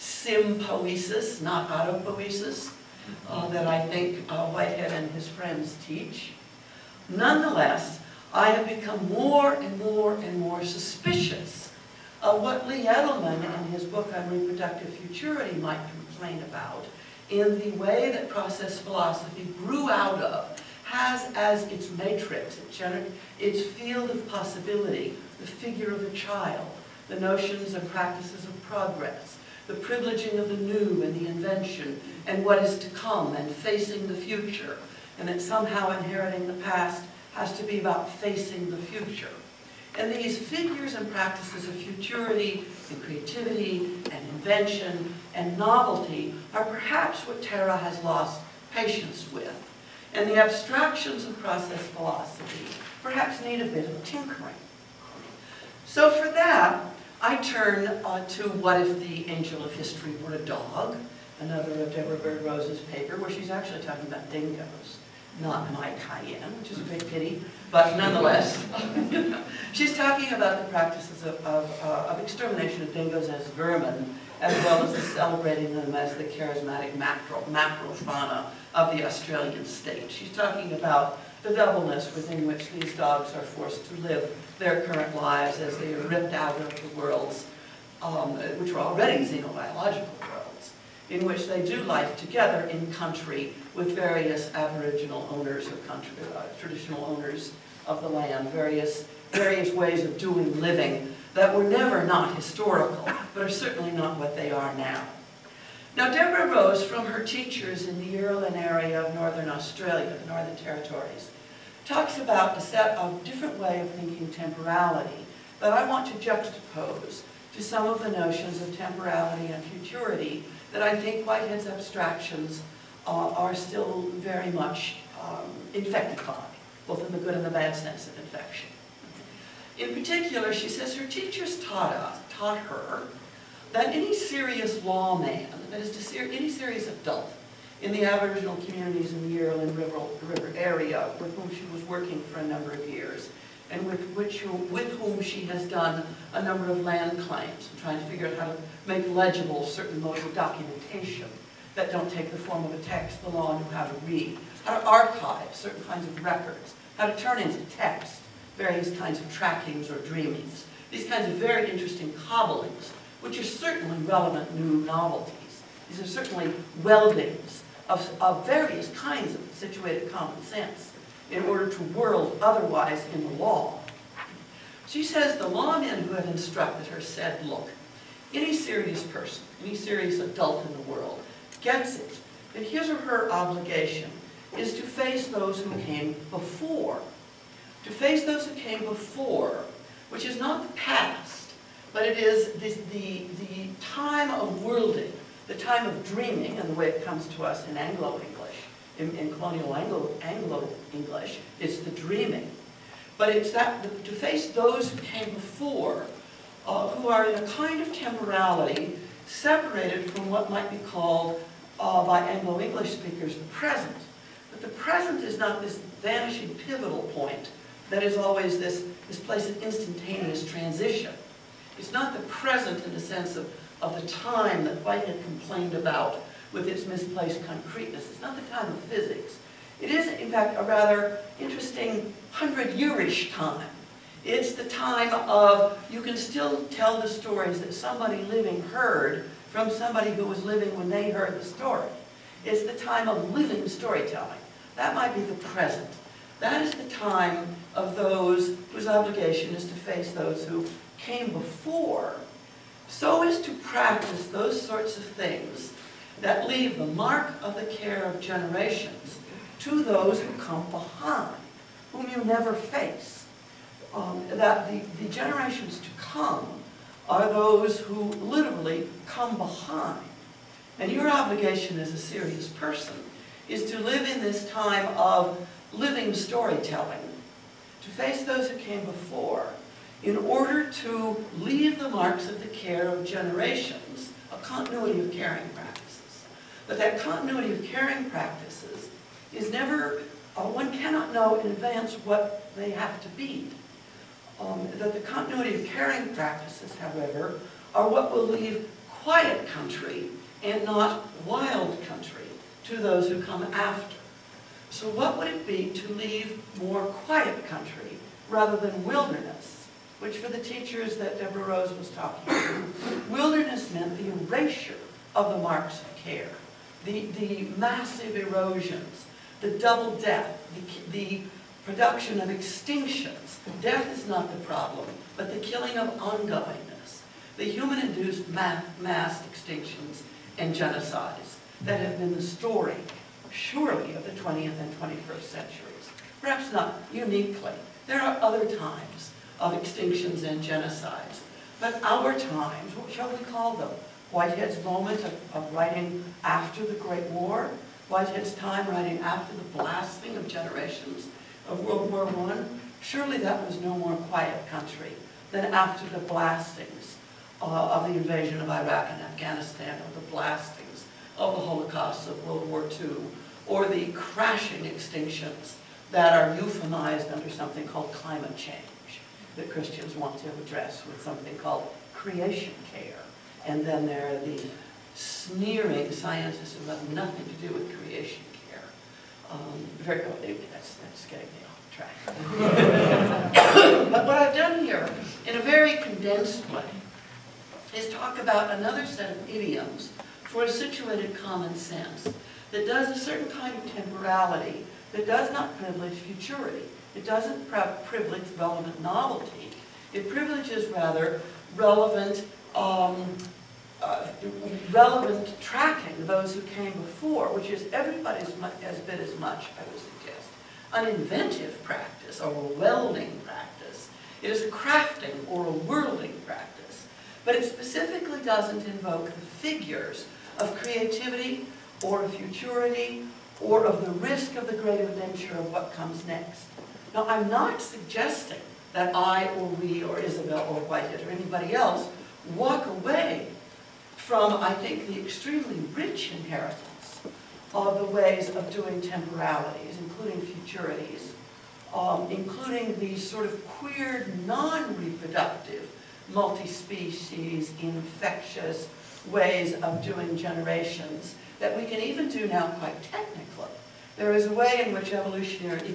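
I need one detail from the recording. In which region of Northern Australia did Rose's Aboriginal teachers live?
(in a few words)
Yarralin.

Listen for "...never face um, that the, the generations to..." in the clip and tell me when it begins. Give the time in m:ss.
4:22.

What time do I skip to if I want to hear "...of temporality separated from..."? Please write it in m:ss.
3:27.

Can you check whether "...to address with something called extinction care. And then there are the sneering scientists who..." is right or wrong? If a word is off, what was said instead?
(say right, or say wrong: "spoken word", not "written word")
wrong: "creation", not "extinction".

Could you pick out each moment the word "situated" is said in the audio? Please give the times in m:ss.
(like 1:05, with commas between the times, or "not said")
2:49, 6:30.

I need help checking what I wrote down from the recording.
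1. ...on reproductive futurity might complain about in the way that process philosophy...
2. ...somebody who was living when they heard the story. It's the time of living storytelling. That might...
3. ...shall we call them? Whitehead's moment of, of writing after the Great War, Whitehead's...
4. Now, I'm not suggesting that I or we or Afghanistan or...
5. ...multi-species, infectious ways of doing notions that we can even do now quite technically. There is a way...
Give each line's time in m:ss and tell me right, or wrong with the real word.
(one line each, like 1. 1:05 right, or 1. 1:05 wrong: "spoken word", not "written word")
1. 0:14 right
2. 3:59 right
3. 5:42 right
4. 7:06 wrong: "Isabelle", not "Afghanistan"
5. 7:26 wrong: "generations", not "notions".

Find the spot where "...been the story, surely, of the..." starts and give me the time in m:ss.
5:31.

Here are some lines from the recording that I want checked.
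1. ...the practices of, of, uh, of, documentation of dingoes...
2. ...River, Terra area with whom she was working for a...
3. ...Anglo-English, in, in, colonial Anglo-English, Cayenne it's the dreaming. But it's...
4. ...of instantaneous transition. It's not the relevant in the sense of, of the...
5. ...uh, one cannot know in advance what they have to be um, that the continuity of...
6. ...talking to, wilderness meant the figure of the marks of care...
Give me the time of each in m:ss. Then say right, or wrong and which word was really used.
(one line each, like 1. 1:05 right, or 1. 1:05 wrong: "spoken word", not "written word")
1. 1:10 wrong: "extermination", not "documentation"
2. 2:19 wrong: "River", not "Terra"
3. 3:17 wrong: "Anglo", not "Cayenne"
4. 3:39 wrong: "present", not "relevant"
5. 4:50 right
6. 5:11 wrong: "erasure", not "figure".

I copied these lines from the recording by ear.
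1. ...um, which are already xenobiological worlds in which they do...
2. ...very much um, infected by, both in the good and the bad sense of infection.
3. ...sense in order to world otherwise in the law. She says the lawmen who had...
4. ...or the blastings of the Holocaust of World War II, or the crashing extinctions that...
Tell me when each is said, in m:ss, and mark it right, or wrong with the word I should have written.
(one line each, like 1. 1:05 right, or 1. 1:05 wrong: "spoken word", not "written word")
1. 1:28 right
2. 2:04 right
3. 2:50 right
4. 5:59 right.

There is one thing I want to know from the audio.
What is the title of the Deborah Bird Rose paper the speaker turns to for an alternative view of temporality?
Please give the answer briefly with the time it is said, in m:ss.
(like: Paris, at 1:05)
What If the Angel of History Were a Dog, at 0:58.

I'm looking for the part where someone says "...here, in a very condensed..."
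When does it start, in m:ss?
6:24.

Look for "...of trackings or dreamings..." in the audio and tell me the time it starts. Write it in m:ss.
2:39.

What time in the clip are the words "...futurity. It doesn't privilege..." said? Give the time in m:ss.
6:35.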